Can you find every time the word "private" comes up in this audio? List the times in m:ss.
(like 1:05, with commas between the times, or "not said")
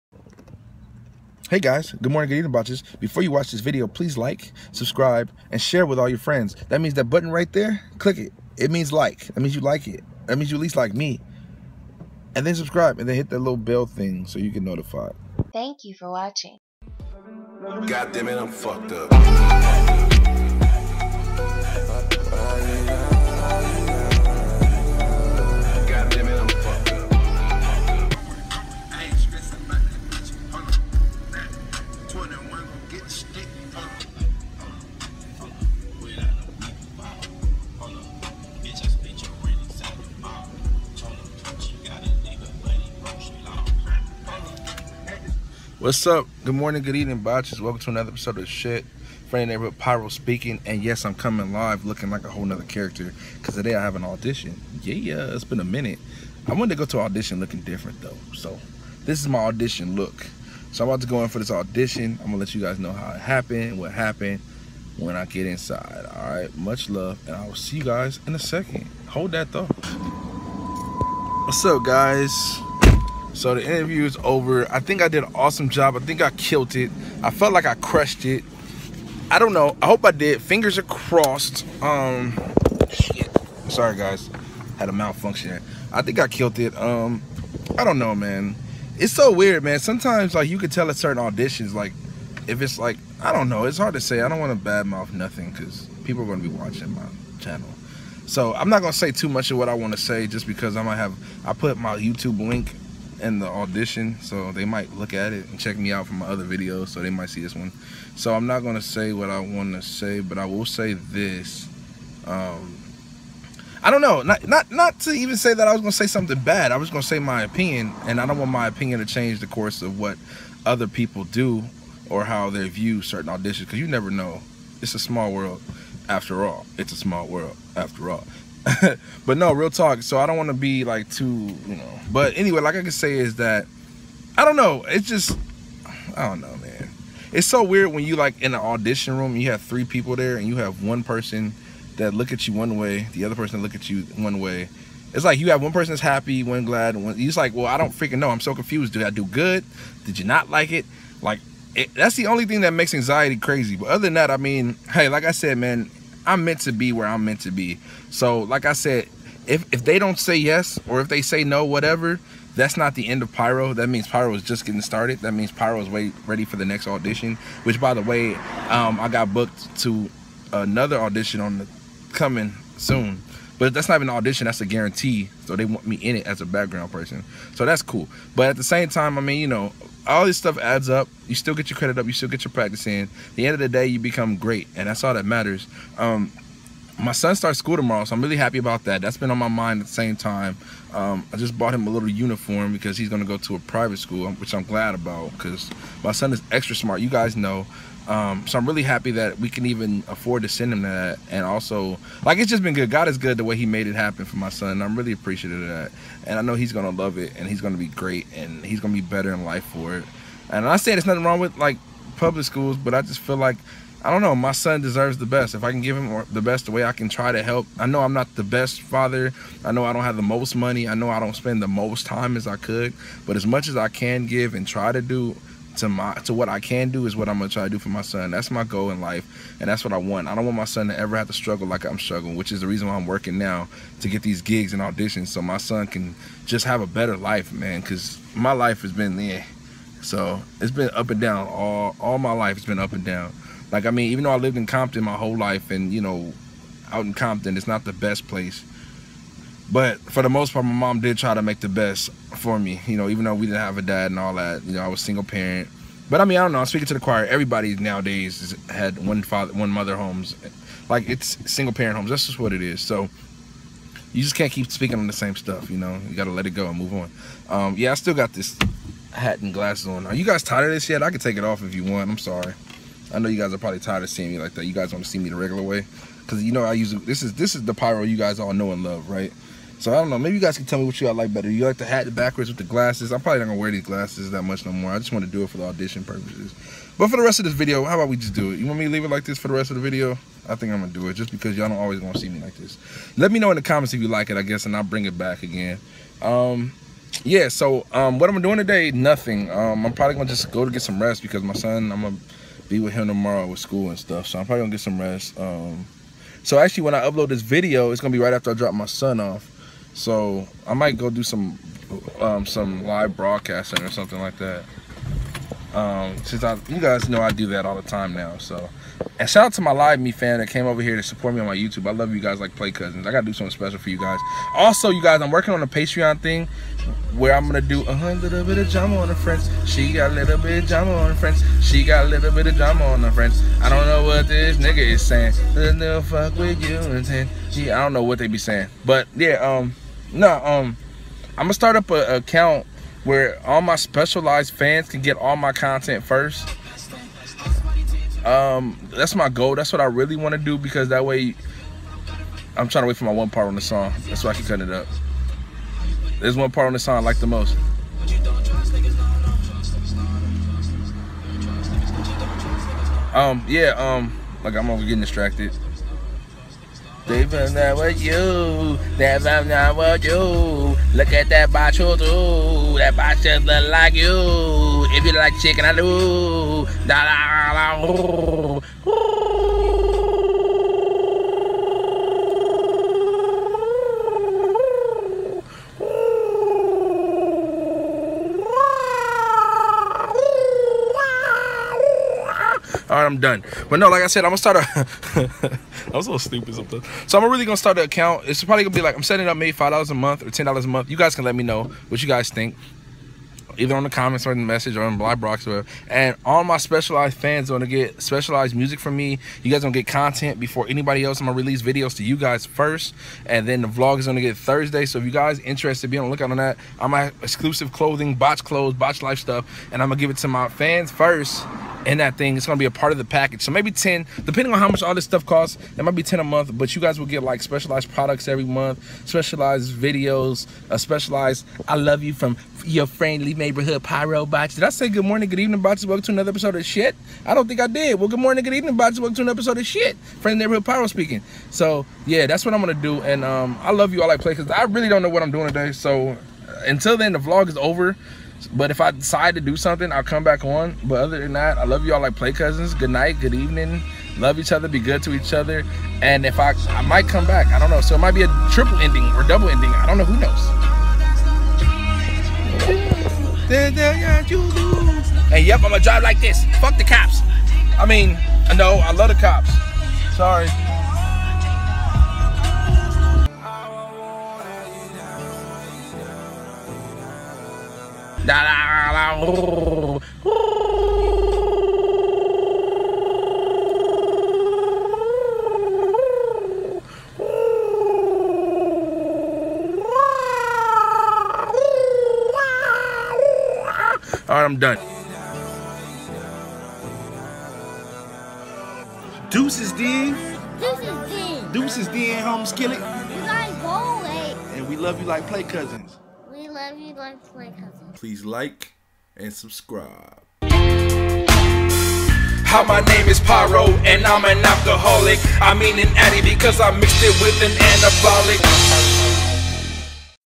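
3:13.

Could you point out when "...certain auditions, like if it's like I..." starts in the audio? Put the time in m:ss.
1:30.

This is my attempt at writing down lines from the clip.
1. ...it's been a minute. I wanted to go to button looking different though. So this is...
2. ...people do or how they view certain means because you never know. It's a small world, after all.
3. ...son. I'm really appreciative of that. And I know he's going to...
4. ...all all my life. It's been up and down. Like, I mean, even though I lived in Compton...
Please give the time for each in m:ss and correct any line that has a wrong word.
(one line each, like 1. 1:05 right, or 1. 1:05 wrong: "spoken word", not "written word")
1. 0:55 wrong: "audition", not "button"
2. 2:00 wrong: "auditions", not "means"
3. 3:24 right
4. 4:01 right.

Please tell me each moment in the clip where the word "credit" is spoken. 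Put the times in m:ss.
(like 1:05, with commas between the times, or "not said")
3:01.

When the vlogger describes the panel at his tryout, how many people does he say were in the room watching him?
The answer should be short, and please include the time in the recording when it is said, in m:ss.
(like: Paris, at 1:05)
3, at 2:19.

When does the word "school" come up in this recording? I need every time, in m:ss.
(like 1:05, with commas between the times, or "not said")
3:07, 3:13, 3:32, 5:03.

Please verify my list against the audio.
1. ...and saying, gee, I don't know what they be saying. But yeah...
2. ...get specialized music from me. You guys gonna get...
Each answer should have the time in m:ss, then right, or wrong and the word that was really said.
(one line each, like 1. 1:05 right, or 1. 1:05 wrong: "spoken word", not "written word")
1. 5:36 right
2. 6:47 right.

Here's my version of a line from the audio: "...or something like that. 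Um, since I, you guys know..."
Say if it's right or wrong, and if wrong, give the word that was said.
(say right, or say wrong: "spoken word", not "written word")
right.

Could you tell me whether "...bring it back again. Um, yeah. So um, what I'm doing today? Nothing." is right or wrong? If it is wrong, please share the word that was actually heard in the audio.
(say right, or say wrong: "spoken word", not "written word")
right.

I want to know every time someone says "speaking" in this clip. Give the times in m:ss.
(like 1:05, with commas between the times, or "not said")
0:50, 4:16, 4:24, 7:20.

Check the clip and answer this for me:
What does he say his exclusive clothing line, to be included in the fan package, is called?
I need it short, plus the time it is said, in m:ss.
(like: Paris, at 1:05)
Botch clothes, at 6:58.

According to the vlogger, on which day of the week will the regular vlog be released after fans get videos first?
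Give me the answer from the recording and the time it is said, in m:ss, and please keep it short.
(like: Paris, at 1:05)
Thursday, at 6:54.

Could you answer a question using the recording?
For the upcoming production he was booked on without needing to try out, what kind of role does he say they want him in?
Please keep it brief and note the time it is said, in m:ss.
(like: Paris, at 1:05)
Background person, at 2:56.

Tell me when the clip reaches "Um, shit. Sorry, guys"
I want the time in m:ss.
1:21.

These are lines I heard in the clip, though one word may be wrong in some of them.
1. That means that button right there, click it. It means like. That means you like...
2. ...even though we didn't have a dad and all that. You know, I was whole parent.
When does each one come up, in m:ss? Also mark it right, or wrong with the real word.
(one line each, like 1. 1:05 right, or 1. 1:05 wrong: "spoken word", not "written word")
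1. 0:06 right
2. 4:13 wrong: "single", not "whole".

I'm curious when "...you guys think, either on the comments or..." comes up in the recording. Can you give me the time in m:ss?
6:42.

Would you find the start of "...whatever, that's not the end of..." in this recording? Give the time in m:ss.
2:41.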